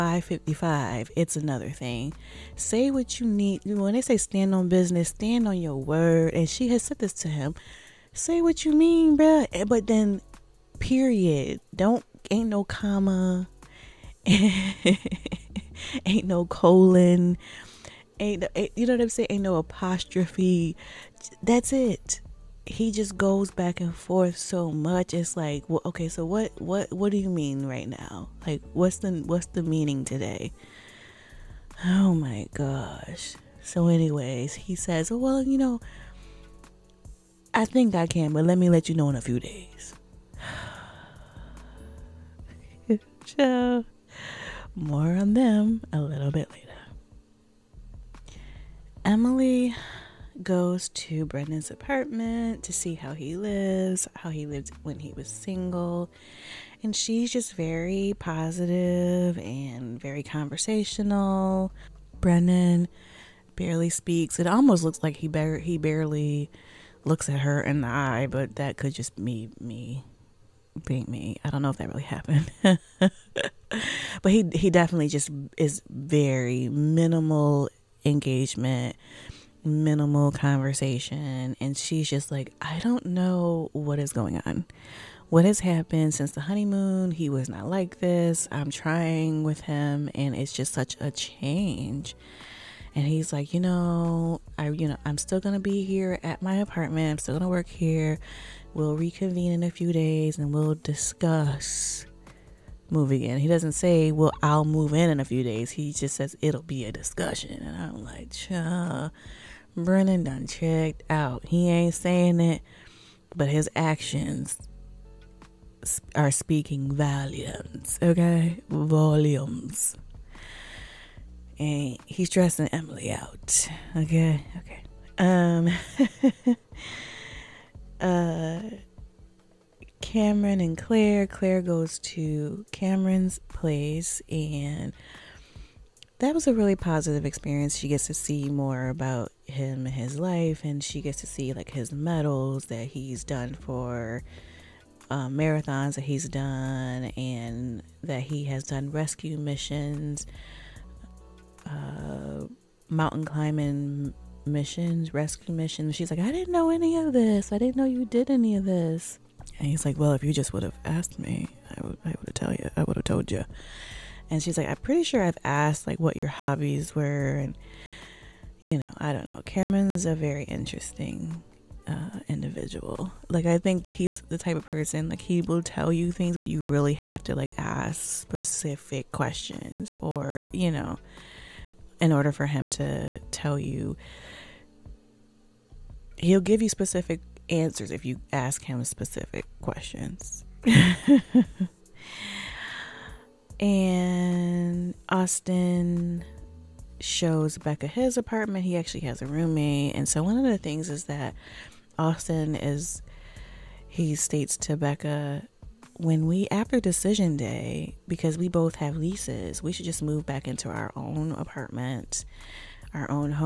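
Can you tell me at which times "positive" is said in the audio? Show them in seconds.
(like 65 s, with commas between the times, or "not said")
58 s, 136 s.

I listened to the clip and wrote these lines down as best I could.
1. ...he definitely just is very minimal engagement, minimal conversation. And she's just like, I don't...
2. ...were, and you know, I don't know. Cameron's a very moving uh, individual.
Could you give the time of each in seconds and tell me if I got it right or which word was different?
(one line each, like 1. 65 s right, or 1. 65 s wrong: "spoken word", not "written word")
1. 74 s right
2. 166 s wrong: "interesting", not "moving".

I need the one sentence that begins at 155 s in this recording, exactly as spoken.
She's like, I didn't know any of this.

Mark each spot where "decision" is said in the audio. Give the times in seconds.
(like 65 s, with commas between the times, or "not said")
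206 s.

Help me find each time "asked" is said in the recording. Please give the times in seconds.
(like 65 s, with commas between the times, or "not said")
160 s, 165 s.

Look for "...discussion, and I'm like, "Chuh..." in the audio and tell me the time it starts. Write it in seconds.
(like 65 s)
106 s.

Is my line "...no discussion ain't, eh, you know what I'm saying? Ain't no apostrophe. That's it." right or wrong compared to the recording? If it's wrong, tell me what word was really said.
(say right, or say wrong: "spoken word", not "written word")
wrong: "colon", not "discussion".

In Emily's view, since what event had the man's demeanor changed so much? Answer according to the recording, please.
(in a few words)
the honeymoon.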